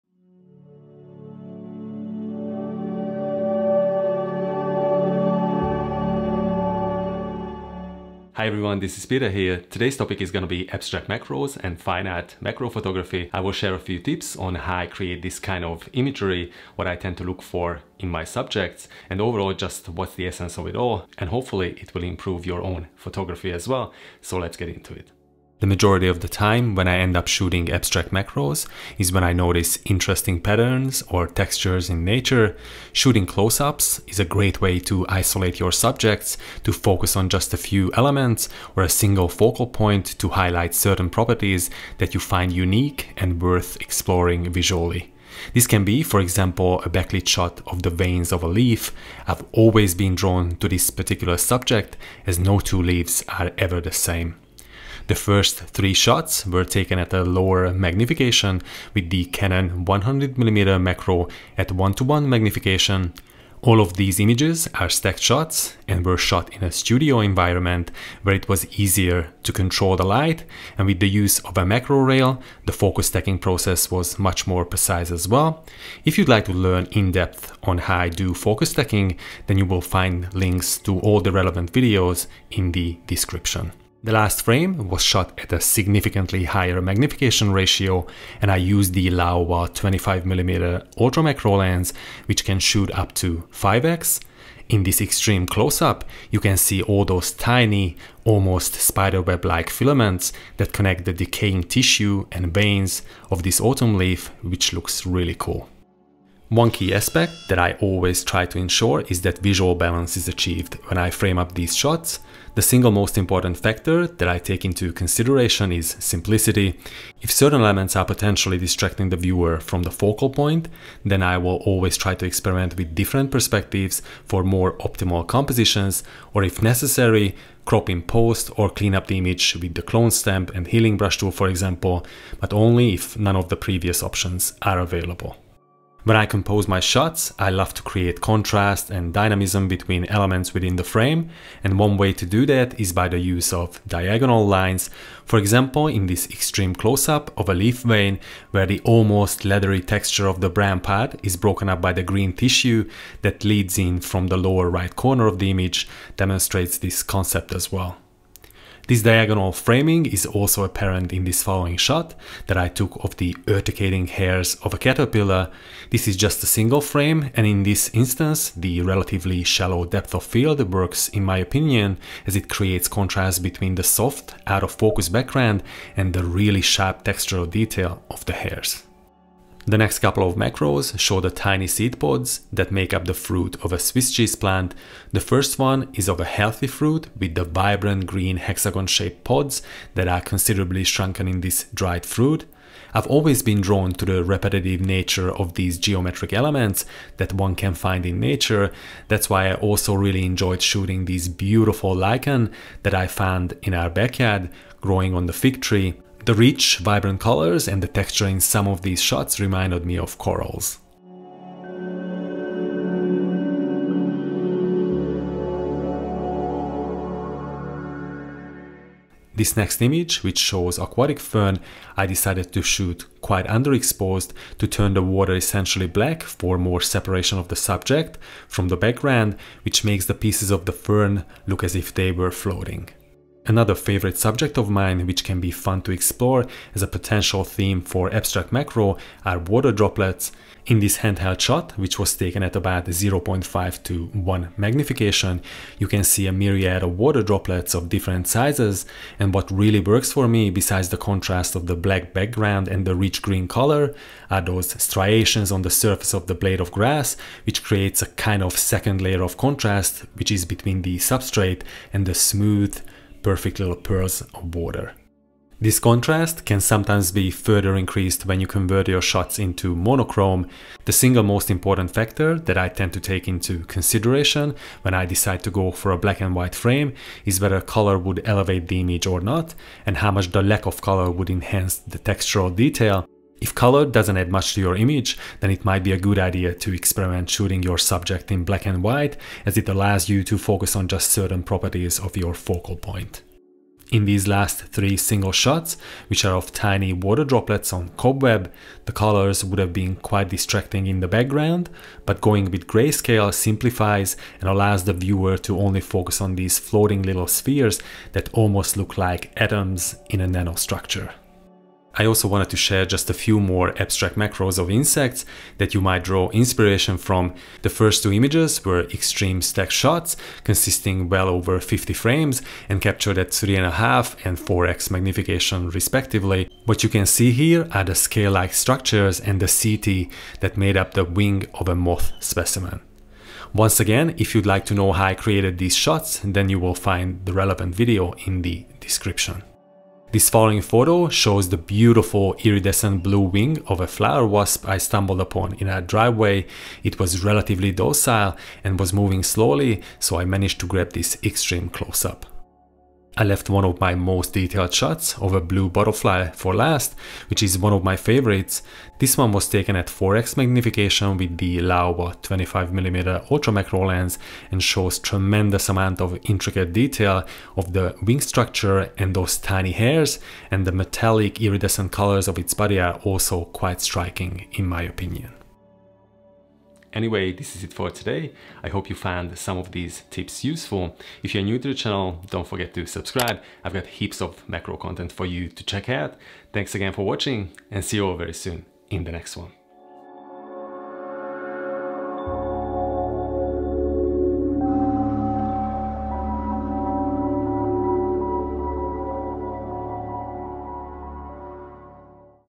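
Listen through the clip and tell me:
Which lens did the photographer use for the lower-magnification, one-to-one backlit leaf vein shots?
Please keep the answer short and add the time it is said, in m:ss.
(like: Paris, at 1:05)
Canon 100mm macro, at 0:59.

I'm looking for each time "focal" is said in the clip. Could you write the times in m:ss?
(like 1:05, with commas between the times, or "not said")
0:39, 1:59, 4:52.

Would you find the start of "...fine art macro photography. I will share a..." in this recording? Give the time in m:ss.
0:11.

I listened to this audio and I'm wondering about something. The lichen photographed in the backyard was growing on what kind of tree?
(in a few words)
Fig tree.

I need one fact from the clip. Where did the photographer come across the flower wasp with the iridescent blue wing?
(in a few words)
A driveway.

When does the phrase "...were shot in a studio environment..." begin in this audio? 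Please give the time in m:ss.
1:06.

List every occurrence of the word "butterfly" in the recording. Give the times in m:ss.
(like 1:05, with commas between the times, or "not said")
5:55.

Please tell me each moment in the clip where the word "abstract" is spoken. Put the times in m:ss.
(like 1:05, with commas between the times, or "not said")
0:10, 0:27, 3:58, 5:13.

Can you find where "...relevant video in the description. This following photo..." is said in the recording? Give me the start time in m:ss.
5:37.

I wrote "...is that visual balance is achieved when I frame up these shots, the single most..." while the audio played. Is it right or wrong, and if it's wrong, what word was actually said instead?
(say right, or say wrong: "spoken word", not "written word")
right.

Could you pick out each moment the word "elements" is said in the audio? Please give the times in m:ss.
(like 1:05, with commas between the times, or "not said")
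0:37, 1:57, 2:20, 3:16.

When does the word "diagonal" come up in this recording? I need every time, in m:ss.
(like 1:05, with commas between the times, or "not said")
2:23, 2:39.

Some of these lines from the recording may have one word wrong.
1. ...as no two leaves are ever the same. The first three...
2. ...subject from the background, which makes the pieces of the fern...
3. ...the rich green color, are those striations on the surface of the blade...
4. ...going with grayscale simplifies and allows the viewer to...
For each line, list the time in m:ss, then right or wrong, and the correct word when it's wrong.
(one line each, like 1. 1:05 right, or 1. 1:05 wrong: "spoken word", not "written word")
1. 0:52 right
2. 3:47 right
3. 4:12 right
4. 5:02 right.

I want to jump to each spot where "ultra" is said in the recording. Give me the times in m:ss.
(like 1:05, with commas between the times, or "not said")
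1:30, 6:03.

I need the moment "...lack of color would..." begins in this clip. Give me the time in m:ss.
4:40.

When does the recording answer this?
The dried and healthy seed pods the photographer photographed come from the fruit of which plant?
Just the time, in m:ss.
3:03.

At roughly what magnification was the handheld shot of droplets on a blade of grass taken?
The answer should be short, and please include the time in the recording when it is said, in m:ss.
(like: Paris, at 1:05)
0.5 to 1, at 4:02.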